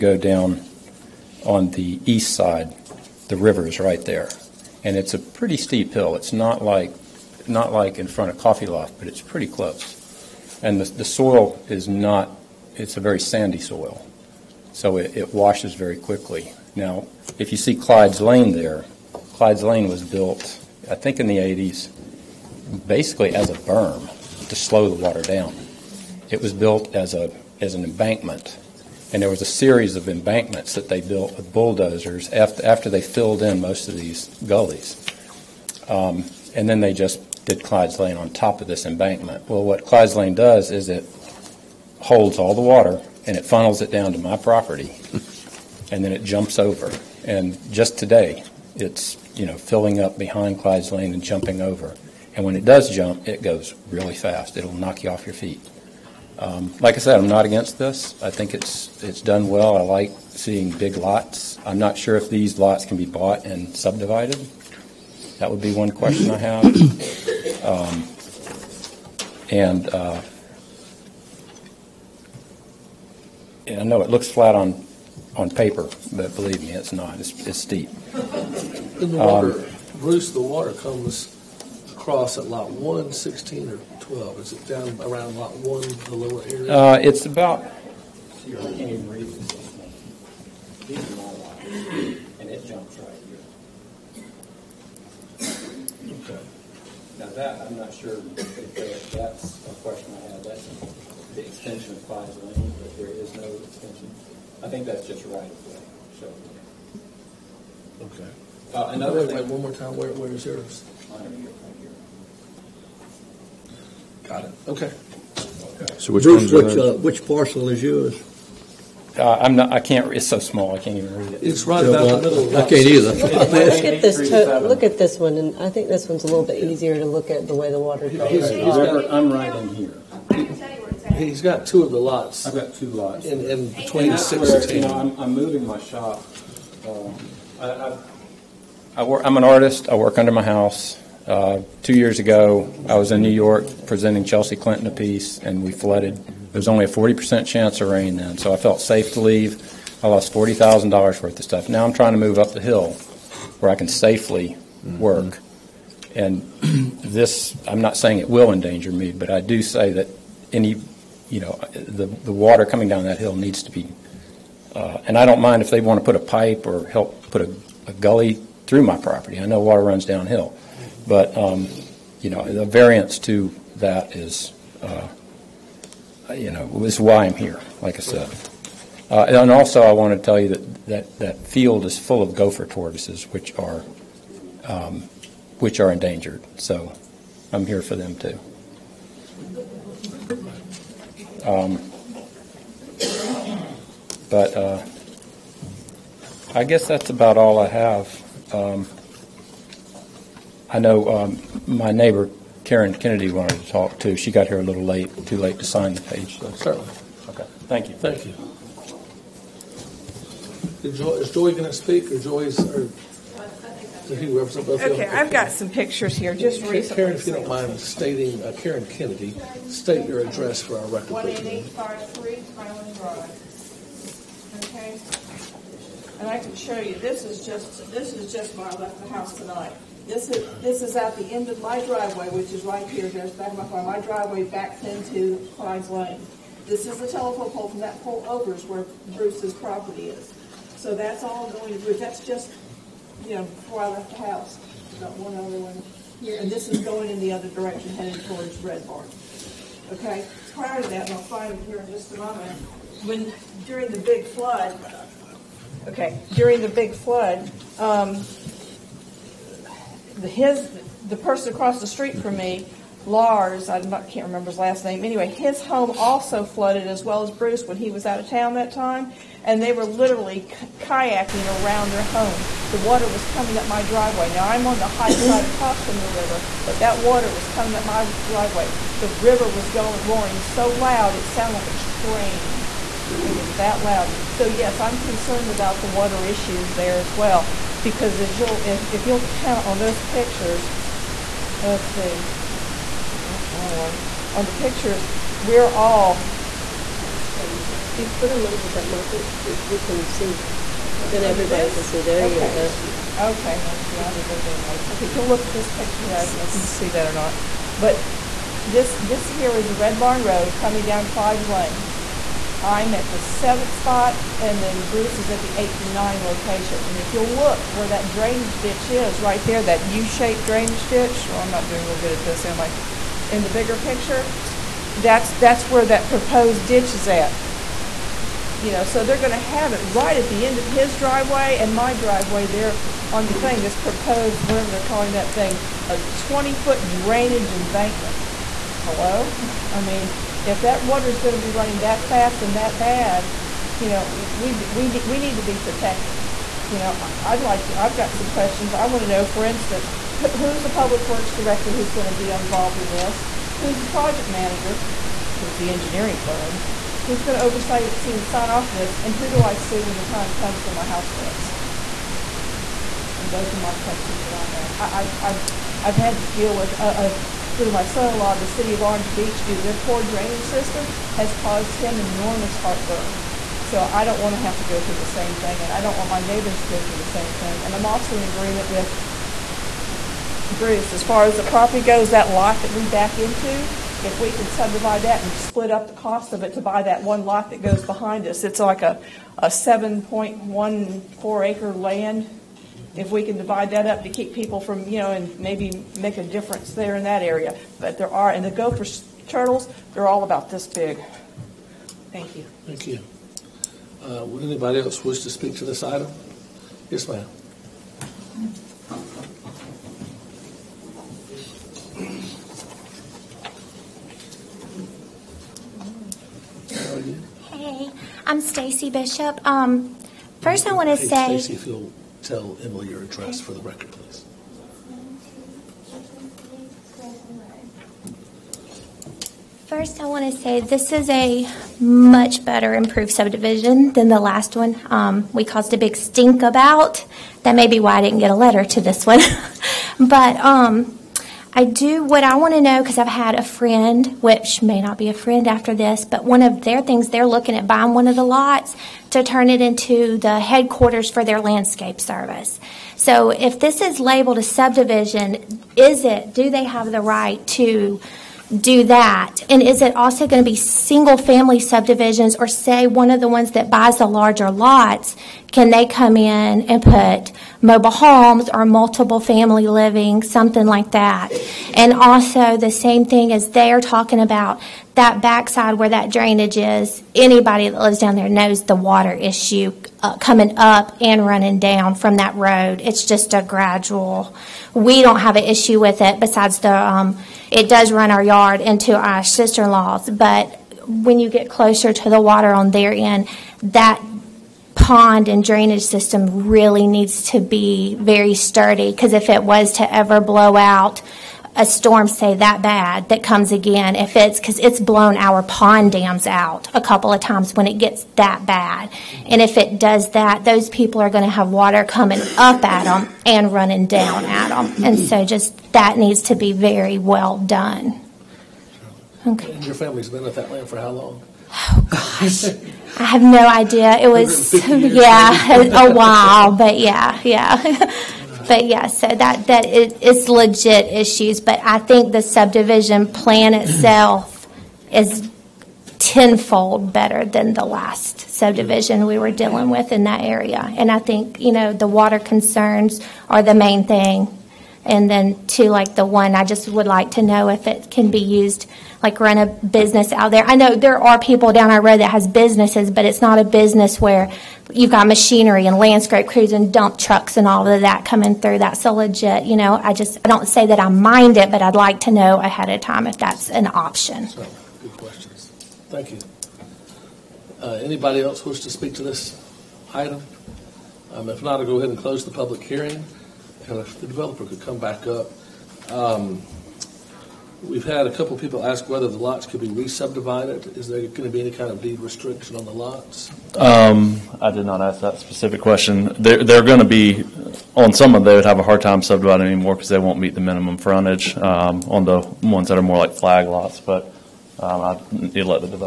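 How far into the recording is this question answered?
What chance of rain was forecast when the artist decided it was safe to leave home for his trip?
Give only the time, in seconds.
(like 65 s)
146 s.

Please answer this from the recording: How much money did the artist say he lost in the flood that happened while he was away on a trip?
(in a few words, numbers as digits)
$40,000.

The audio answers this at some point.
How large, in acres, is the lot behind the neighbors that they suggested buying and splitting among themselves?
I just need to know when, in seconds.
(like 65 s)
389 s.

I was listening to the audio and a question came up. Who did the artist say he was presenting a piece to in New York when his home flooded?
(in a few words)
Chelsea Clinton.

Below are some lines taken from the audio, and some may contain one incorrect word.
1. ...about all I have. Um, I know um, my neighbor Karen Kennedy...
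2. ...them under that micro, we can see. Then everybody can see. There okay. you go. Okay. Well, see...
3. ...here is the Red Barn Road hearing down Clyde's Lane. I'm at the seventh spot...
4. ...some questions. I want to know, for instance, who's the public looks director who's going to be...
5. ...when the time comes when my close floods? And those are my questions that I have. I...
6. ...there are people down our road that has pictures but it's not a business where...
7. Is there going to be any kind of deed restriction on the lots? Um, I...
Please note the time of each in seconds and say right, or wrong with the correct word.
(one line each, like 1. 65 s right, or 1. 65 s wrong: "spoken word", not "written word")
1. 197 s right
2. 298 s right
3. 309 s wrong: "coming", not "hearing"
4. 348 s wrong: "works", not "looks"
5. 359 s wrong: "house", not "close"
6. 550 s wrong: "businesses", not "pictures"
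7. 580 s right.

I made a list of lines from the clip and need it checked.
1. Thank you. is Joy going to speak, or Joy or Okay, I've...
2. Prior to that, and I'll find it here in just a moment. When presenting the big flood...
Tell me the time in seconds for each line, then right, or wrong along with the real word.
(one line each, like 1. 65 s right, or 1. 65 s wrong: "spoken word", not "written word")
1. 207 s right
2. 250 s wrong: "during", not "presenting".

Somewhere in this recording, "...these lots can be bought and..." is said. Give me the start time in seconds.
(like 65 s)
62 s.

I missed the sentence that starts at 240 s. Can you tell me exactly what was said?
So that's all going to Bruce.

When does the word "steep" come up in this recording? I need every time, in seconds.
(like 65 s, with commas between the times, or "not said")
5 s, 77 s.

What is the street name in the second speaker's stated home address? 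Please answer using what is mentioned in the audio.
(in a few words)
Highland Drive.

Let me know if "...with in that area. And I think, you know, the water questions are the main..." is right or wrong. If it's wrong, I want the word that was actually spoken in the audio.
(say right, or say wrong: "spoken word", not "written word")
wrong: "concerns", not "questions".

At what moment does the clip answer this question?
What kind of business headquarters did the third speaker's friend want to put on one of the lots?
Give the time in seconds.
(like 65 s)
451 s.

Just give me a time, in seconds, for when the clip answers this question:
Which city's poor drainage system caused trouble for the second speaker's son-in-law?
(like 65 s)
368 s.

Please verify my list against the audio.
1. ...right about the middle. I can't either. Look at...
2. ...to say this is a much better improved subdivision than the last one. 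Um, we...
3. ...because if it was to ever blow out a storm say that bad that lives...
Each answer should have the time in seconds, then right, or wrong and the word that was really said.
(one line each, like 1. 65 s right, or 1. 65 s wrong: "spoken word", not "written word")
1. 121 s right
2. 430 s right
3. 498 s wrong: "comes", not "lives".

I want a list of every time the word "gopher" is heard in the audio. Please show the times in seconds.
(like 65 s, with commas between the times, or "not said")
182 s, 398 s.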